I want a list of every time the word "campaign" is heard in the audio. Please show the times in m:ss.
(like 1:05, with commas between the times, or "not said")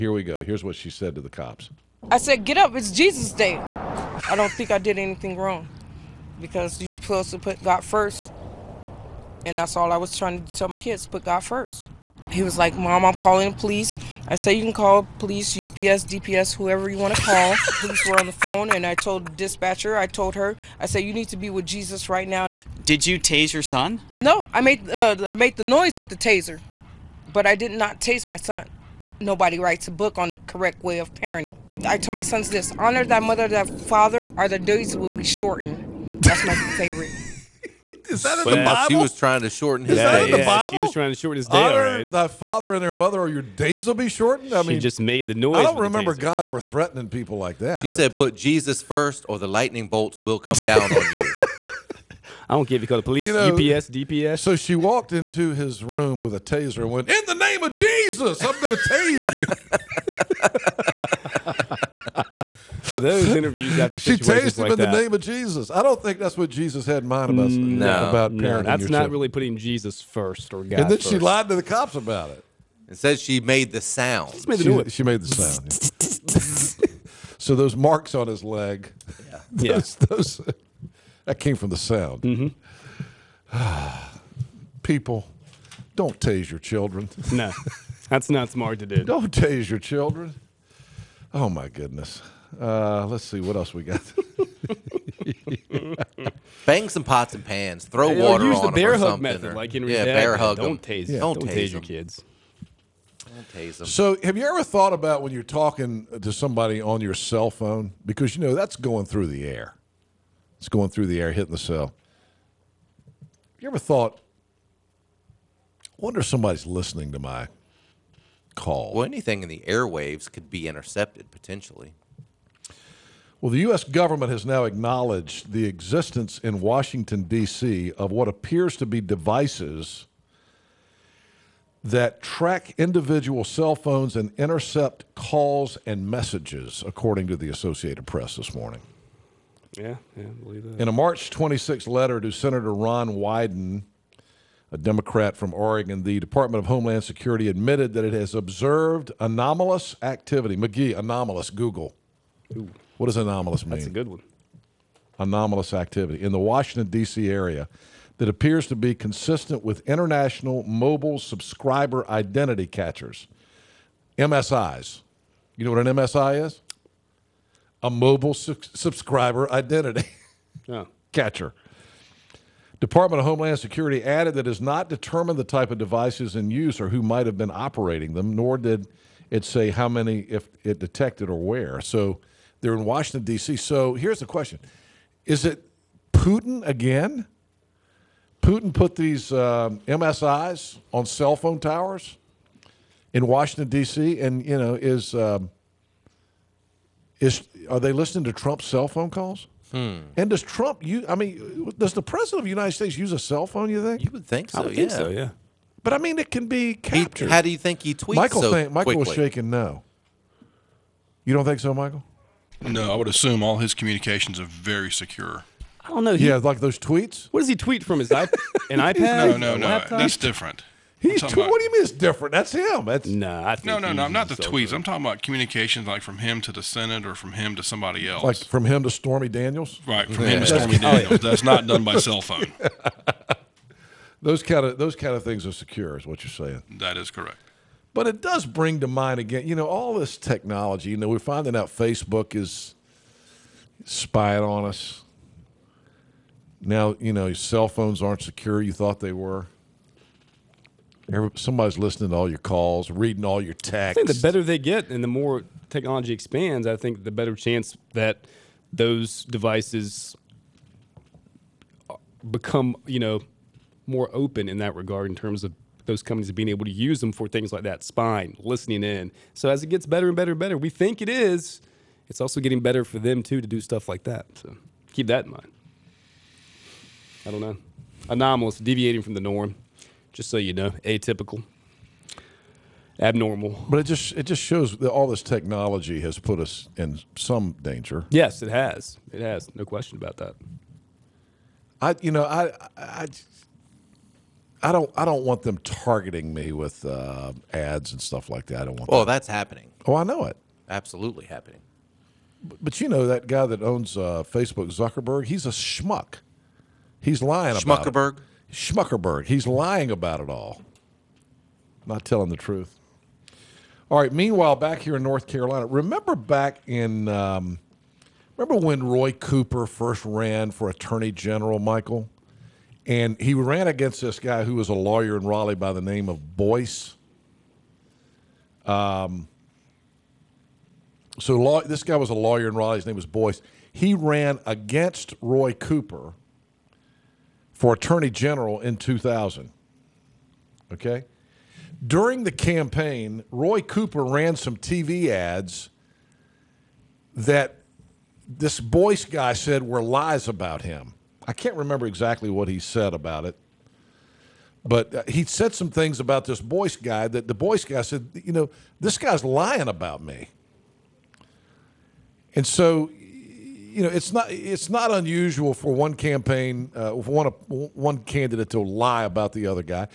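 5:42, 6:05.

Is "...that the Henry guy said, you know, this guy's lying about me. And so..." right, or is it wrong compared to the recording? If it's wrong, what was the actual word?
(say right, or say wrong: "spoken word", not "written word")
wrong: "Boyce", not "Henry".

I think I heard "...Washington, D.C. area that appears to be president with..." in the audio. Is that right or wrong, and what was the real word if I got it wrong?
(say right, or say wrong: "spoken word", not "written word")
wrong: "consistent", not "president".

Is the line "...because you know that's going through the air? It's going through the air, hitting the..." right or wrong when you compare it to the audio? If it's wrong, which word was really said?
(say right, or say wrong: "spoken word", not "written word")
right.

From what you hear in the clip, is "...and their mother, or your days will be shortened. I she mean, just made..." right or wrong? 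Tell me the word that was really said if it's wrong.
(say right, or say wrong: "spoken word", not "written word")
right.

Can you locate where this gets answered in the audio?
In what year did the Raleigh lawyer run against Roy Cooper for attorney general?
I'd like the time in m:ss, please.
5:38.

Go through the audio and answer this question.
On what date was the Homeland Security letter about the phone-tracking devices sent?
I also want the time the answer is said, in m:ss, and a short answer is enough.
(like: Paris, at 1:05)
March 26, at 2:20.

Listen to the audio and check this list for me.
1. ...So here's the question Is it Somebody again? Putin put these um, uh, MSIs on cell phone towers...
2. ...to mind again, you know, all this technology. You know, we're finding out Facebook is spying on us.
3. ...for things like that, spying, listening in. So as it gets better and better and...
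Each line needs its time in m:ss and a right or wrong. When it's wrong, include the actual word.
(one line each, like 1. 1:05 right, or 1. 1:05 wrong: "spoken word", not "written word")
1. 3:03 wrong: "Putin", not "Somebody"
2. 3:58 right
3. 4:27 right.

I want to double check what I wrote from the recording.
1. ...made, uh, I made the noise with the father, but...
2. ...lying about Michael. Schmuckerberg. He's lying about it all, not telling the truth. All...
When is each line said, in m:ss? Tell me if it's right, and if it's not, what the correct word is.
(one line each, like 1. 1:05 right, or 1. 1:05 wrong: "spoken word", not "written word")
1. 0:24 wrong: "taser", not "father"
2. 5:07 wrong: "Schmuckerberg", not "Michael".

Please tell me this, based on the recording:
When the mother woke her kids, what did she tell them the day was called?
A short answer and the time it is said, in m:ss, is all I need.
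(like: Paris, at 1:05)
Jesus Day, at 0:02.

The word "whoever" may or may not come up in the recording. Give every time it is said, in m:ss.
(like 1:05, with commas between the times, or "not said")
0:16.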